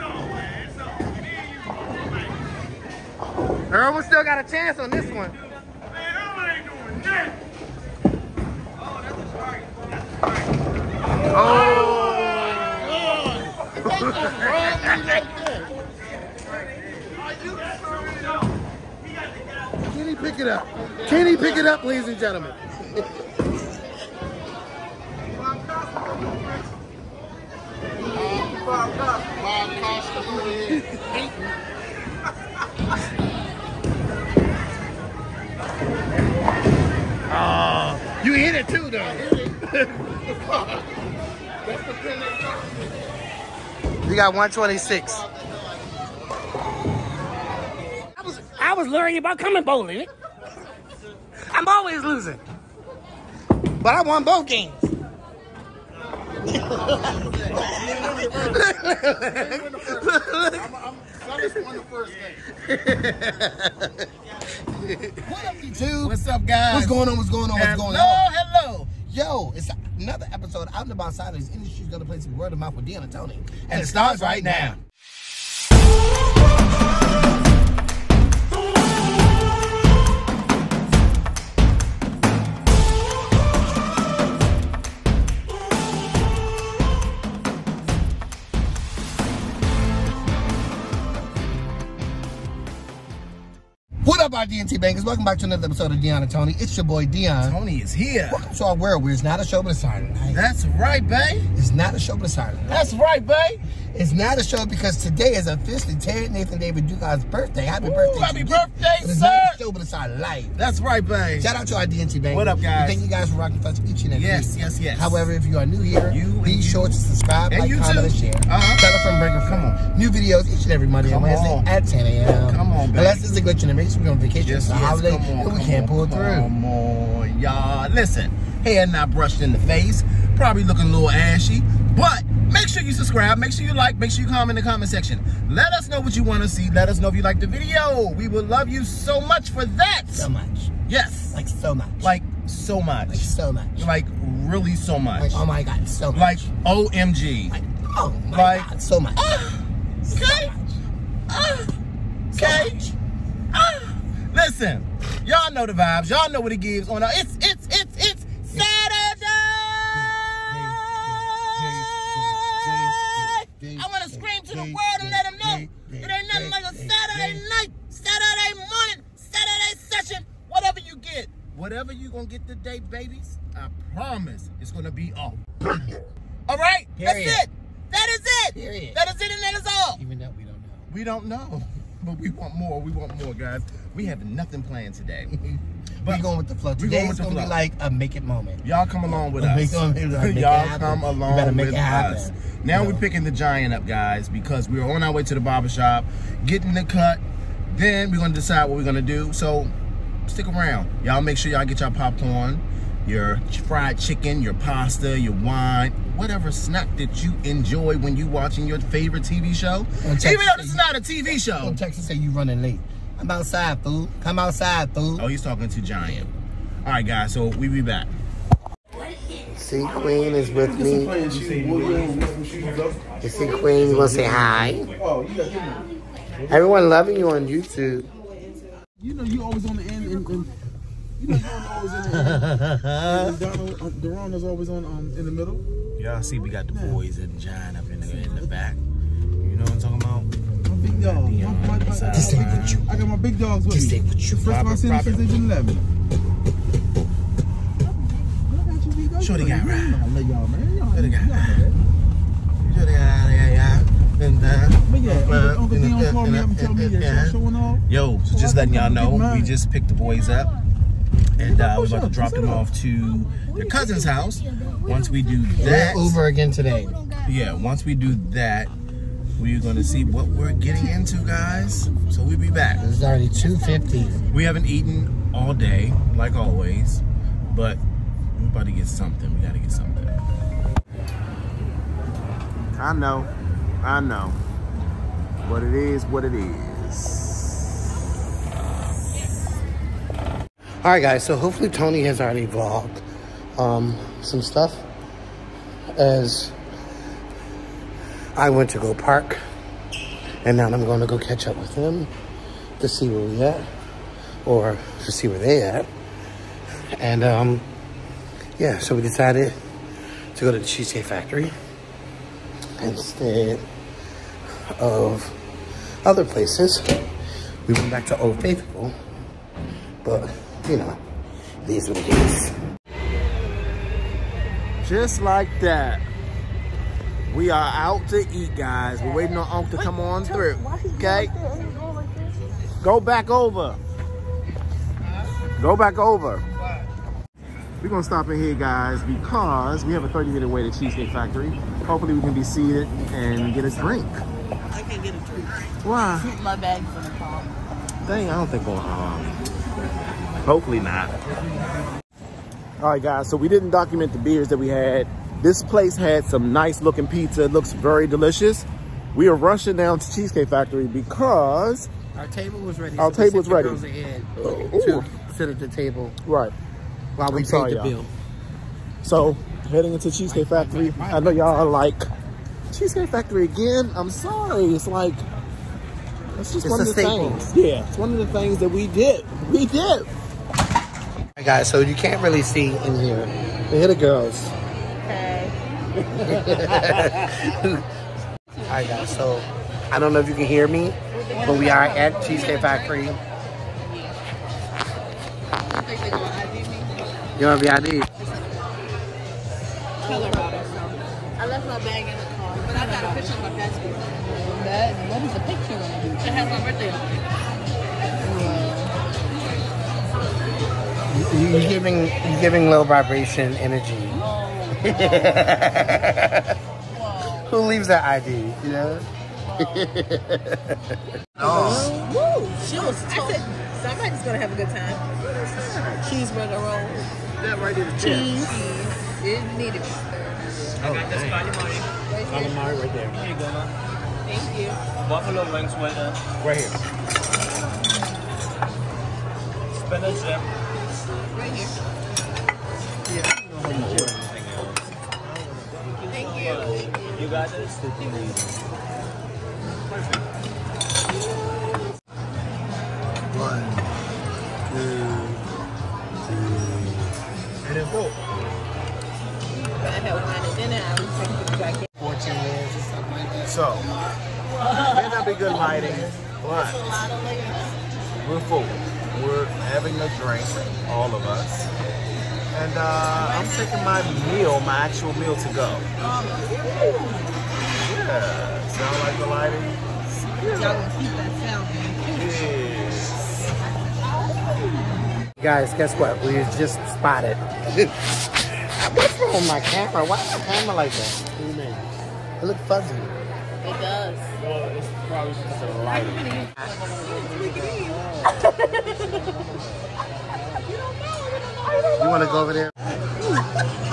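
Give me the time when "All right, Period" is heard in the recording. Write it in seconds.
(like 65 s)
176 s.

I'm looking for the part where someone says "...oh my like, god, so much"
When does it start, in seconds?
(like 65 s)
147 s.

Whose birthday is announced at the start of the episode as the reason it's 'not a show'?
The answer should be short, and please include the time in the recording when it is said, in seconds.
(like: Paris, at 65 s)
Terry Nathan David Dugan, at 105 s.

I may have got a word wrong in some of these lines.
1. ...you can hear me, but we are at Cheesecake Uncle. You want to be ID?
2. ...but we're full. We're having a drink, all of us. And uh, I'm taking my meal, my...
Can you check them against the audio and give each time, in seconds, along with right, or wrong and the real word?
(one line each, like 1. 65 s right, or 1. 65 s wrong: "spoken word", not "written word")
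1. 390 s wrong: "Factory", not "Uncle"
2. 466 s right.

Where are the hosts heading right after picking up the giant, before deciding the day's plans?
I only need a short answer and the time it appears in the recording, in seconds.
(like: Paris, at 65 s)
the barbershop, at 195 s.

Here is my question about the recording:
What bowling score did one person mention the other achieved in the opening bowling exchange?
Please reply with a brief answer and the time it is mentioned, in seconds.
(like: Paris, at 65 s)
126, at 44 s.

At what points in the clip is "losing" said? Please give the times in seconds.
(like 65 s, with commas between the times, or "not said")
52 s.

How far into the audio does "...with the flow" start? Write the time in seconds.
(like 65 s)
186 s.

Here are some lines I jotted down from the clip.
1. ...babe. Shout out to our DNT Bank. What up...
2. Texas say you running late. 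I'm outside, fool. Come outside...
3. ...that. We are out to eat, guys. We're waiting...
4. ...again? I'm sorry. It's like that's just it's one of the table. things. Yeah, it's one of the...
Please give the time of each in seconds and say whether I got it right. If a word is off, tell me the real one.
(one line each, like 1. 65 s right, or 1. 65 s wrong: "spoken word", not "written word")
1. 111 s right
2. 211 s right
3. 325 s right
4. 373 s wrong: "staple", not "table".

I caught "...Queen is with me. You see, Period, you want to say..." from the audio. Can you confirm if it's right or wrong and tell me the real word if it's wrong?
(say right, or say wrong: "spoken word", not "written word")
wrong: "Queen", not "Period".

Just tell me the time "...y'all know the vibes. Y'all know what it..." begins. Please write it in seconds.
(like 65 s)
155 s.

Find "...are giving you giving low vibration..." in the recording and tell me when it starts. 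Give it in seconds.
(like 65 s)
411 s.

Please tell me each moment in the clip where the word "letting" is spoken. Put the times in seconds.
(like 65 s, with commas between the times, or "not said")
258 s.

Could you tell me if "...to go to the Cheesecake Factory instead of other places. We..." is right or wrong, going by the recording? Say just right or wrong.
right.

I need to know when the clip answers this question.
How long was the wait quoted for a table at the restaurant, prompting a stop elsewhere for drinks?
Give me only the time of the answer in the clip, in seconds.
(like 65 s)
340 s.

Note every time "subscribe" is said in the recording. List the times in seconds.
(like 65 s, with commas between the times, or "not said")
116 s, 132 s.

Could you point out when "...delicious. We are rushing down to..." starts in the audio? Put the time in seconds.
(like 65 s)
358 s.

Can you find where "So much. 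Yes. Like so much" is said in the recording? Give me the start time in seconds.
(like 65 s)
140 s.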